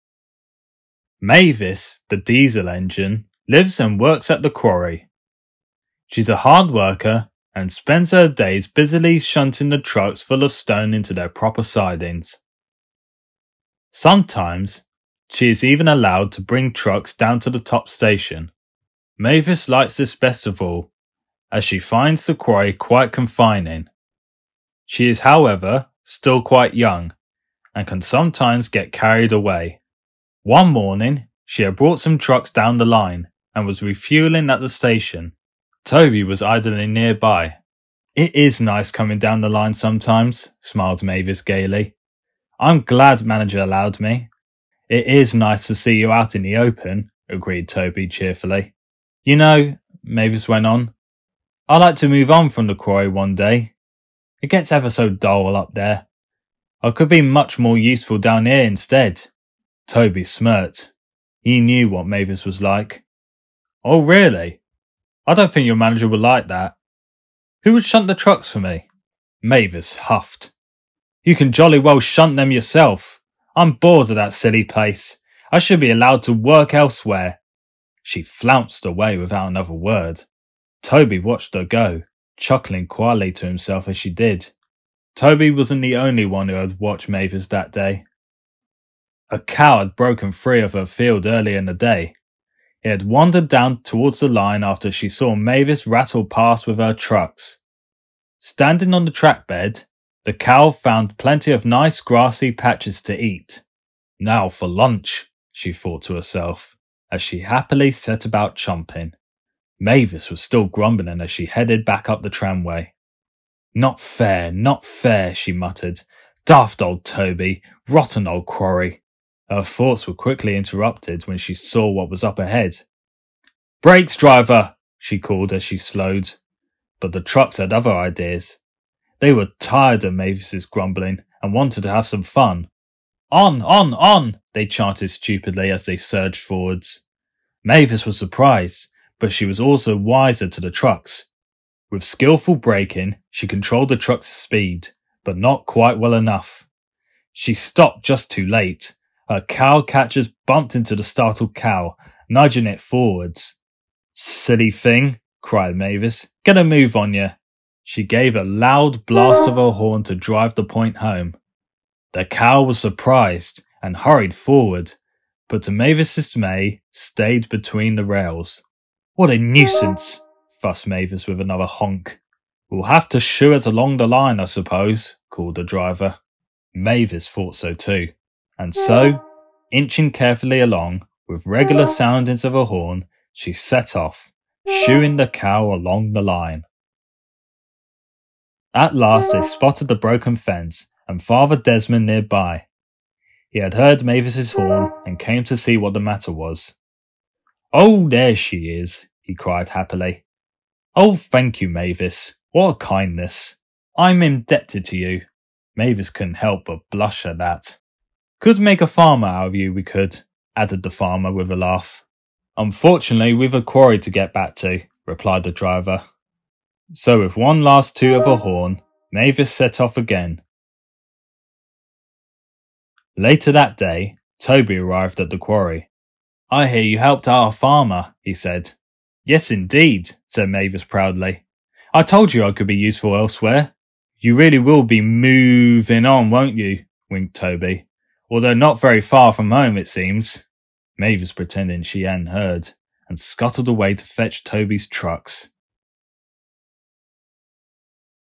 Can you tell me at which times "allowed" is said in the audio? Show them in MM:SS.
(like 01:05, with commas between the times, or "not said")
00:15, 00:43, 01:15.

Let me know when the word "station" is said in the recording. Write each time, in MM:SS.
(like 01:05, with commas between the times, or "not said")
00:17, 00:34.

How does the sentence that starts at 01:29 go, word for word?
A cow had broken free of her field early in the day.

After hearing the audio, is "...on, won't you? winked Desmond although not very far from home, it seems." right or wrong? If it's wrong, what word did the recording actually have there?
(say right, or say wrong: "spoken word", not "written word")
wrong: "Toby", not "Desmond".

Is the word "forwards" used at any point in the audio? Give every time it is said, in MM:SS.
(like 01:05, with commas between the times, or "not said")
02:16, 02:32, 02:44.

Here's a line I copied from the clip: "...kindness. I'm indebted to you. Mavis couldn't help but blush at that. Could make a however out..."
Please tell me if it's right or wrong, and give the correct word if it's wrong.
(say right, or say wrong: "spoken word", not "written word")
wrong: "farmer", not "however".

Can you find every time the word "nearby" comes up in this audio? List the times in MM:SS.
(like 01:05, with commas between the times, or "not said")
00:36, 03:12.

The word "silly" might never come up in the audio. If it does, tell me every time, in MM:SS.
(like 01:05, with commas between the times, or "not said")
01:14, 02:34.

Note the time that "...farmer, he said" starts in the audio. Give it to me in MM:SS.
03:47.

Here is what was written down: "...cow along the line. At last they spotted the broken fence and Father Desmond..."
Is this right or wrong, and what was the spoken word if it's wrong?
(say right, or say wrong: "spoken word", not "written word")
right.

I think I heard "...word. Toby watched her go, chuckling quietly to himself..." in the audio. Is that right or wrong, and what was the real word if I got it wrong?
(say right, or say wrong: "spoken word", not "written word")
right.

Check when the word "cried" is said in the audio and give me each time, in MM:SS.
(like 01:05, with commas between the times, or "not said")
02:35, 03:19.